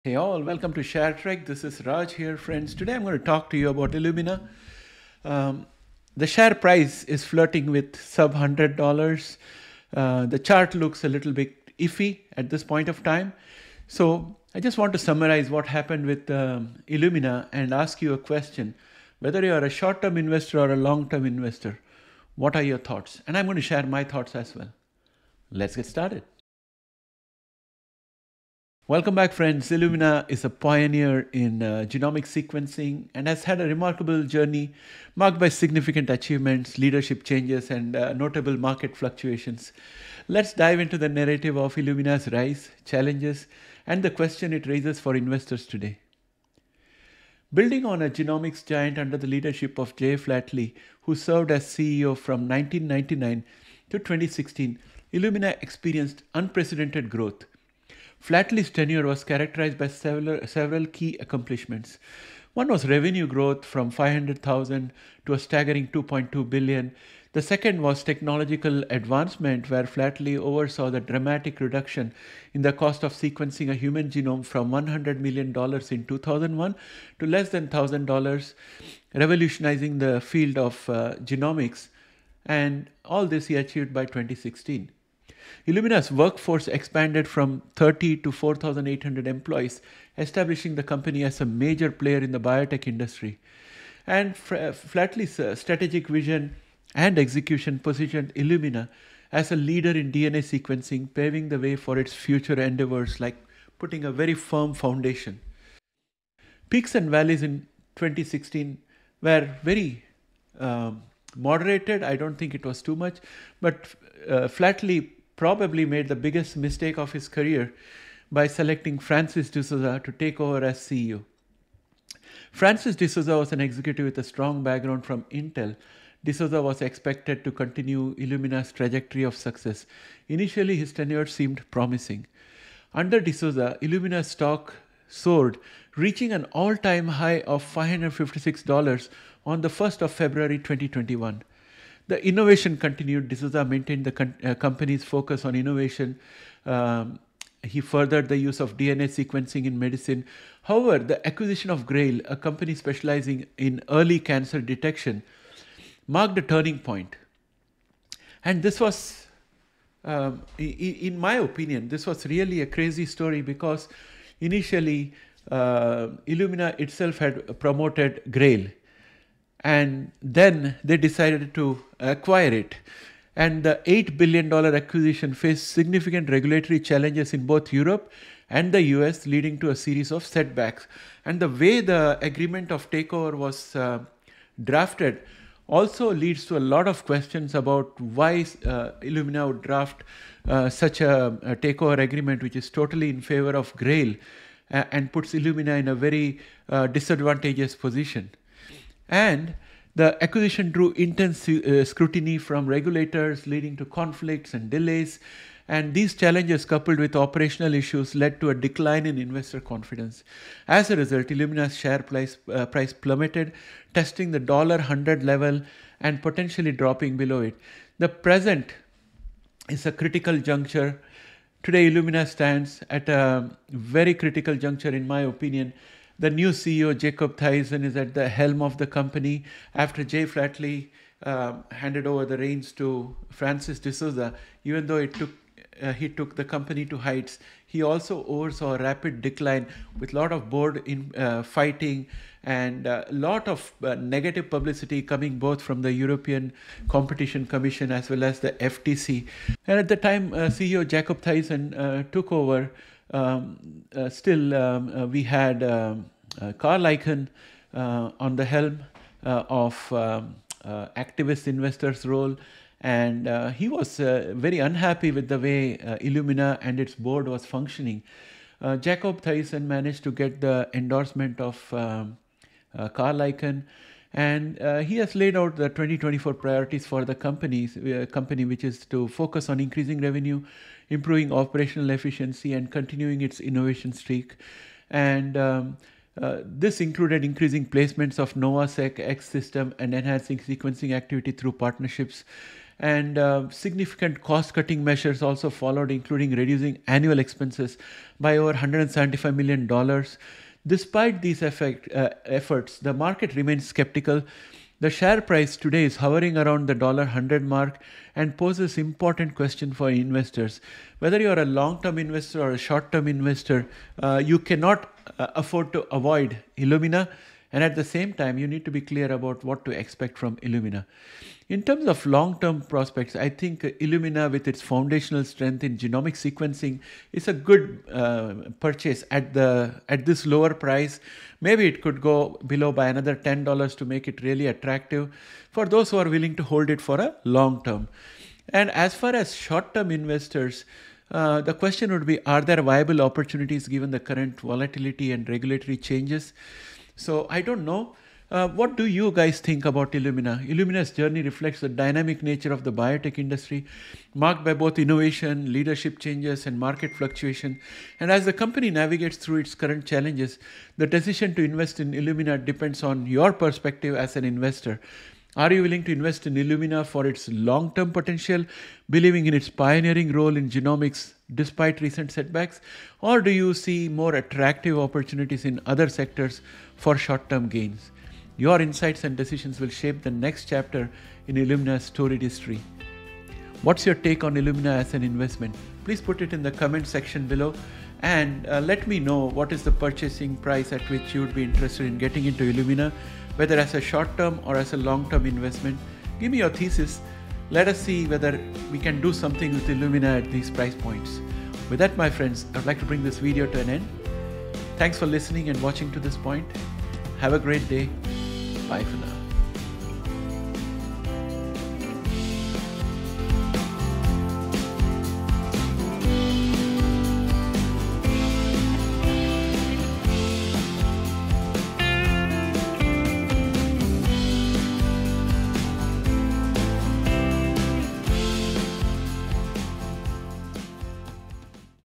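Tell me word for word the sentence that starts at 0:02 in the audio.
Today I'm going to talk to you about Illumina.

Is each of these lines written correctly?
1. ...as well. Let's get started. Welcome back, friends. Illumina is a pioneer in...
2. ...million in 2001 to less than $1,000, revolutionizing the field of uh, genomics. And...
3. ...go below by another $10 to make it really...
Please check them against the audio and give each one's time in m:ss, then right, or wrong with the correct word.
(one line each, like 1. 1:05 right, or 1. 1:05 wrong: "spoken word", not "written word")
1. 0:24 right
2. 1:15 right
3. 5:31 right.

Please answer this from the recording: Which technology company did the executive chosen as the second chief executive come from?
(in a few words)
Intel.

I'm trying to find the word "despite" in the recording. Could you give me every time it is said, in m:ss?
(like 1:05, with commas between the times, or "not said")
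5:00, 6:11.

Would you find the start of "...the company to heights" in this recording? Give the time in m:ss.
3:56.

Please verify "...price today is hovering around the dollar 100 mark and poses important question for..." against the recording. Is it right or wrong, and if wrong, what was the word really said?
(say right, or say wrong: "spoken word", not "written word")
right.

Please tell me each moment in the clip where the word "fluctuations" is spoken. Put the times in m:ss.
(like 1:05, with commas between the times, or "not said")
0:38, 5:56.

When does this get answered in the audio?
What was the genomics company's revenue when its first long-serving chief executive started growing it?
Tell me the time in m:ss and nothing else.
1:03.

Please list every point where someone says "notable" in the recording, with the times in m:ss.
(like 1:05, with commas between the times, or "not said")
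0:38.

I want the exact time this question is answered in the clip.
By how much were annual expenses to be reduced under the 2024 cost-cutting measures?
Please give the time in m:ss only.
4:58.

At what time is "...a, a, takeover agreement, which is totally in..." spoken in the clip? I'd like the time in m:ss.
3:10.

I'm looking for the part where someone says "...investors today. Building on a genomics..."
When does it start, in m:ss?
0:45.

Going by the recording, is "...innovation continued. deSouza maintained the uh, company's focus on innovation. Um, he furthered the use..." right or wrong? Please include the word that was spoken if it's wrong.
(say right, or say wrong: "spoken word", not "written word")
right.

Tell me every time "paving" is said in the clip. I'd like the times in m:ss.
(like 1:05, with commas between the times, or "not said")
1:41.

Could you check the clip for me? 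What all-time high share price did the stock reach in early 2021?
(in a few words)
$556.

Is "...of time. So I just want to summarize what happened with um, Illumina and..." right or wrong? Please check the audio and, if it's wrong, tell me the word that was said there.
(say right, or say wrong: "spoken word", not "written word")
right.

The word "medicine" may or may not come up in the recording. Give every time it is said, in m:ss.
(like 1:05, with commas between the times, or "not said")
2:29.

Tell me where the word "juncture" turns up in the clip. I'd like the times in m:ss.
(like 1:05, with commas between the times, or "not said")
3:40, 3:44.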